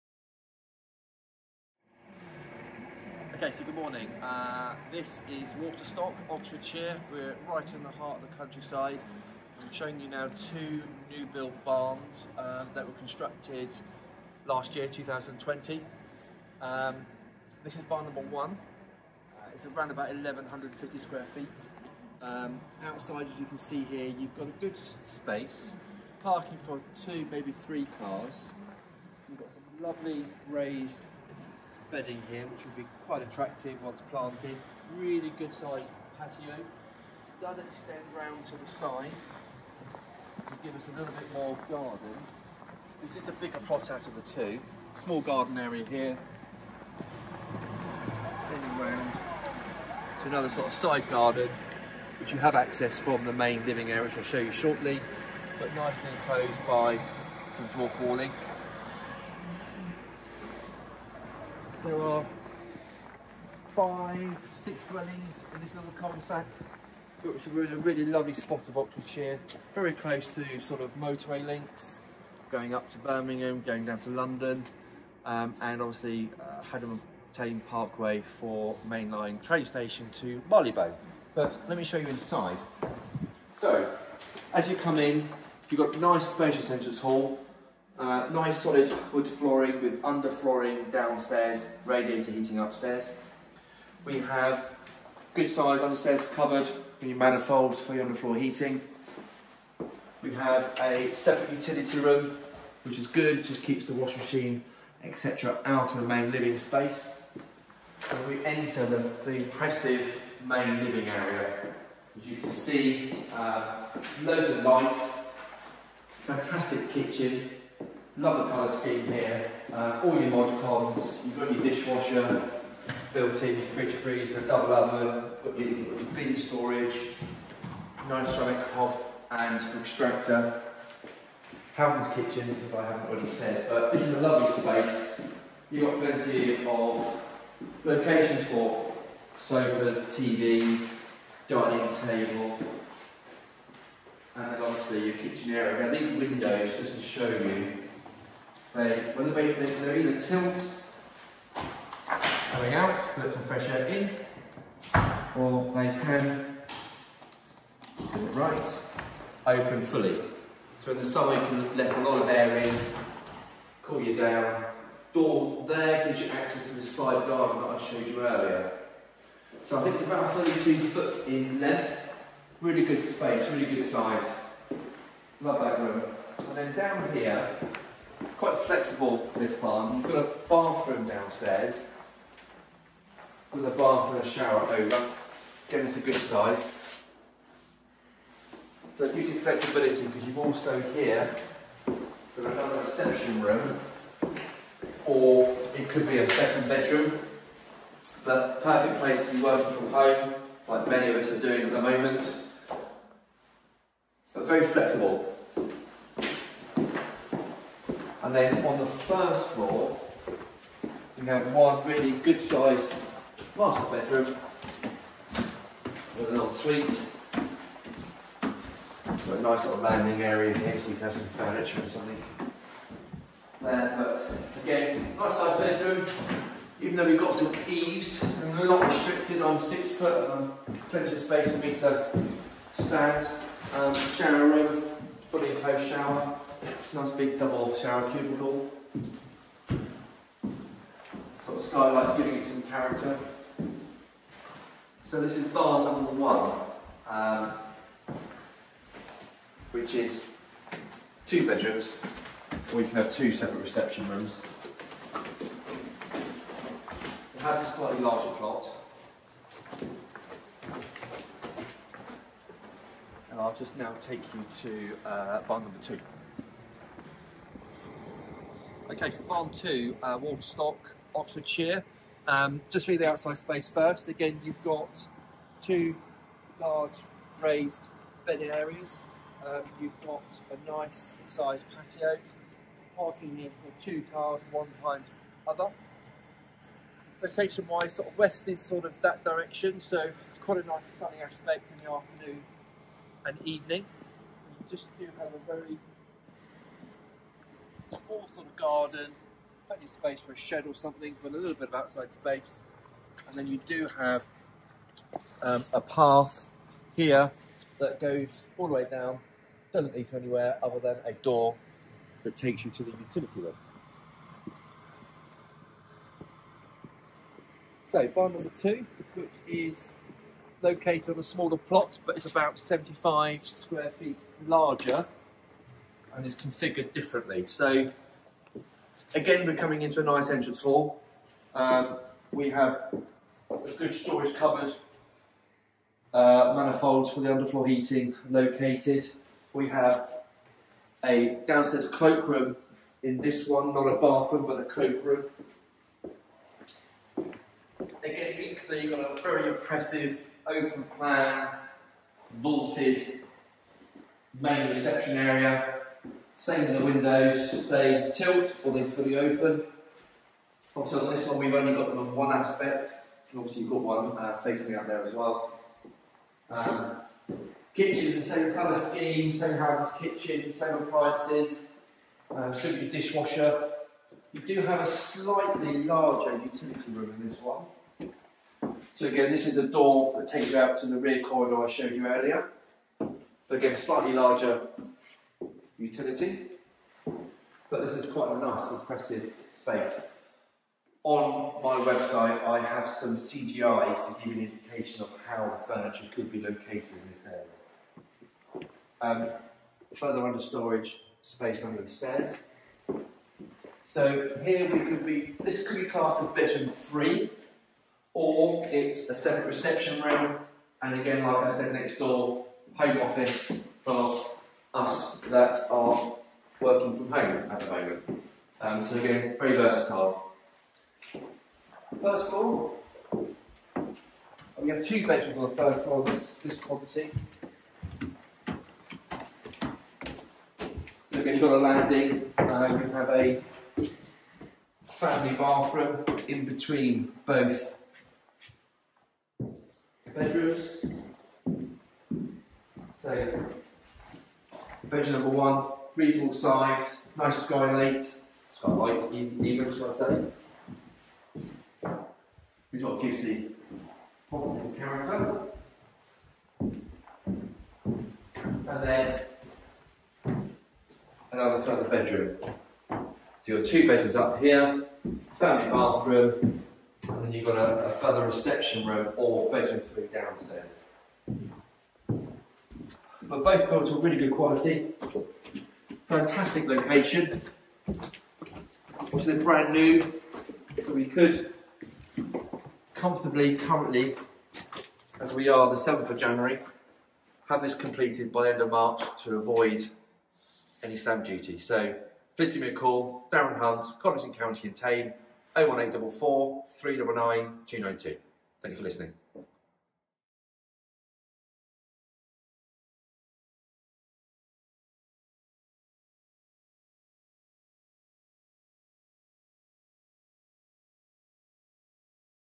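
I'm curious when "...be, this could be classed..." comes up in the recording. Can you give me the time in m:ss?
6:45.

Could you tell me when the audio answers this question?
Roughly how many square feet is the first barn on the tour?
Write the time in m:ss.
0:20.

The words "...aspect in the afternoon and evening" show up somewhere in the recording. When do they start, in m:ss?
4:51.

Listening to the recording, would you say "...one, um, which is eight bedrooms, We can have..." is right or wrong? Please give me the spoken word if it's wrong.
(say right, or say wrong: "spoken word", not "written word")
wrong: "two", not "eight".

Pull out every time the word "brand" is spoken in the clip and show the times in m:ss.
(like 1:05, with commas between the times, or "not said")
7:59.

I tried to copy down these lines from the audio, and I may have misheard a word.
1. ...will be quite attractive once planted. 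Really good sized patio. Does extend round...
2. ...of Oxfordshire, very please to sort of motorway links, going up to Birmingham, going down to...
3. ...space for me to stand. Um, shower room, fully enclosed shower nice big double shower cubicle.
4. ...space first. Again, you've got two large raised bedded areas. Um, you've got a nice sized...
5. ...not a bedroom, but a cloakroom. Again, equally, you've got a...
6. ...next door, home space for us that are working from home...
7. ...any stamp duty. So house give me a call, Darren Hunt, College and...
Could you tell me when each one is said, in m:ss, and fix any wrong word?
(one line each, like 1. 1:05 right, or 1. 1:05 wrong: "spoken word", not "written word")
1. 0:32 right
2. 1:08 wrong: "close", not "please"
3. 3:51 right
4. 4:33 right
5. 5:43 wrong: "bathroom", not "bedroom"
6. 6:51 wrong: "office", not "space"
7. 8:10 wrong: "please", not "house".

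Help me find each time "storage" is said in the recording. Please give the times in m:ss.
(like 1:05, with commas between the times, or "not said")
2:06, 5:33, 6:40.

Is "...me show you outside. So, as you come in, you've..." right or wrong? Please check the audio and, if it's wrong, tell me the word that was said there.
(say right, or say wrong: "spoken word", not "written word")
wrong: "inside", not "outside".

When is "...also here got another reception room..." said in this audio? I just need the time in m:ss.
3:10.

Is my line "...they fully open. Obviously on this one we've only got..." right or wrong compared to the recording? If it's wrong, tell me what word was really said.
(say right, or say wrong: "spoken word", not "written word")
right.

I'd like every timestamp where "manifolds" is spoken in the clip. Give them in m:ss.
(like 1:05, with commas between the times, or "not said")
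1:37, 5:36.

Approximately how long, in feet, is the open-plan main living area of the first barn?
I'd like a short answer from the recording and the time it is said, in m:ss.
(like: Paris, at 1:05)
32 foot, at 2:50.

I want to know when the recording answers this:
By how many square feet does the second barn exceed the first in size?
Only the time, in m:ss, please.
5:22.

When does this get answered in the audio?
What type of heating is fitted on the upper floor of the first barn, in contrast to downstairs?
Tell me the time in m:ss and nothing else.
1:31.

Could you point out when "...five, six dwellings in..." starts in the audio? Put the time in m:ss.
1:03.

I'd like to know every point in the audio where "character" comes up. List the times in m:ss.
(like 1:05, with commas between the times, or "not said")
4:02, 7:34.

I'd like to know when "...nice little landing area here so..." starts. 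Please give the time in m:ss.
3:39.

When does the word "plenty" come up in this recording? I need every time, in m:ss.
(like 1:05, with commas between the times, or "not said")
2:16, 3:50, 4:59.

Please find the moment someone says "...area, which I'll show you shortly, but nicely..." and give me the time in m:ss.
0:53.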